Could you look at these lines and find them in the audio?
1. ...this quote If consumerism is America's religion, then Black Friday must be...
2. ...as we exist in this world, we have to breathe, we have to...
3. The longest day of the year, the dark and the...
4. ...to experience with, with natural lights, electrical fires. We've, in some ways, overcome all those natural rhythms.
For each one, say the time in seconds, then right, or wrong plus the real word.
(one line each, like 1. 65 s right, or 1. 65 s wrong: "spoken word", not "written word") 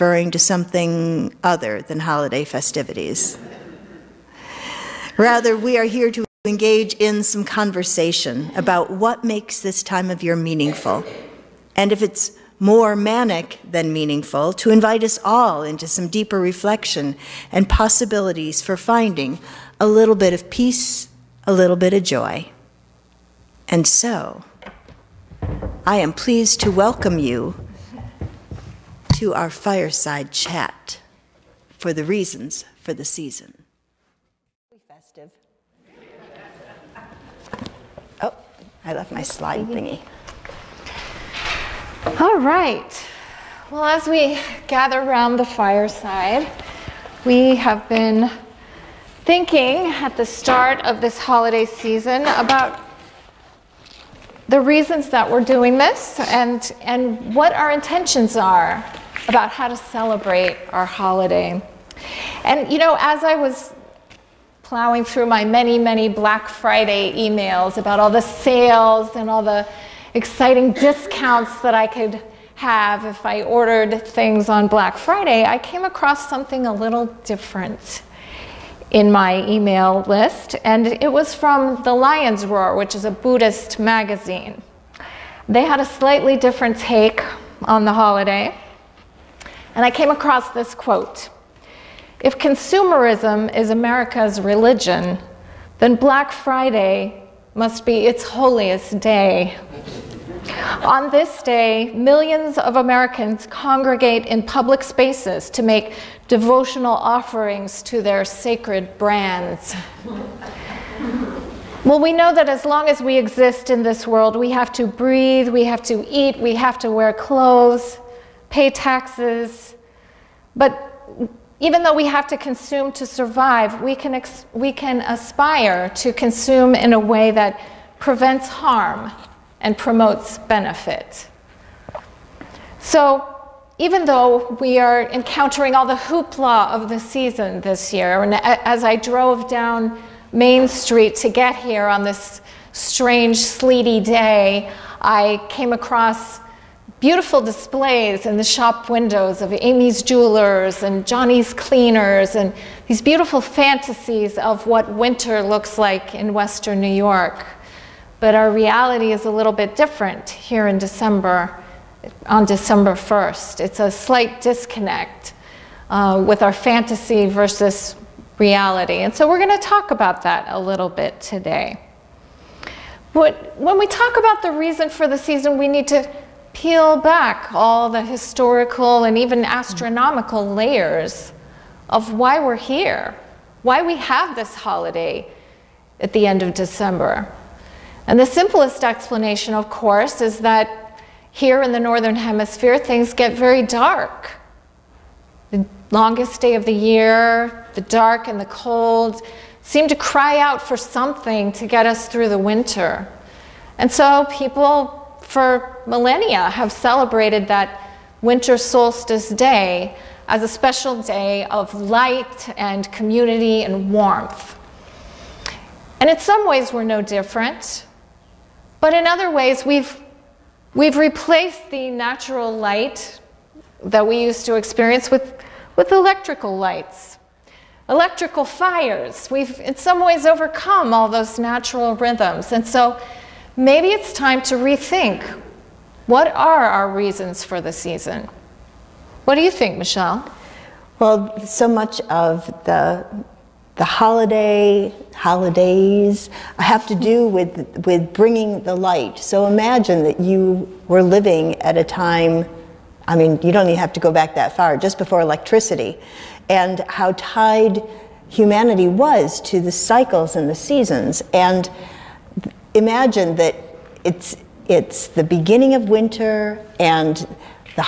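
1. 90 s right
2. 112 s right
3. 195 s right
4. 224 s wrong: "electrical", not "natural".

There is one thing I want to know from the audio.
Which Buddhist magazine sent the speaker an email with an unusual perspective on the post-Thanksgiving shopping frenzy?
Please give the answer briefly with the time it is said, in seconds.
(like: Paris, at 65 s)
The Lion's Roar, at 81 s.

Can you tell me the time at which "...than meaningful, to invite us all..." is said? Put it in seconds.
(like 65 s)
13 s.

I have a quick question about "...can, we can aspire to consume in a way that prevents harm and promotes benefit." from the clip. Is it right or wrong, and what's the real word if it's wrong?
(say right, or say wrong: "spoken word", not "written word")
right.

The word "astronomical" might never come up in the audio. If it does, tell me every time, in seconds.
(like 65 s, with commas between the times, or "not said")
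179 s.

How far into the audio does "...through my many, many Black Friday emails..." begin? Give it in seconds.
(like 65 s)
65 s.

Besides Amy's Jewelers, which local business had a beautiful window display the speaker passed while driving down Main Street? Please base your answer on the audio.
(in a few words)
Johnny's Cleaners.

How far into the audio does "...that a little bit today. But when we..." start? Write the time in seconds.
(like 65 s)
170 s.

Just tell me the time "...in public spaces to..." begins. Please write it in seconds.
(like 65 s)
104 s.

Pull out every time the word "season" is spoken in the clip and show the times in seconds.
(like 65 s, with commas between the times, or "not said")
33 s, 51 s, 136 s, 175 s, 237 s, 260 s.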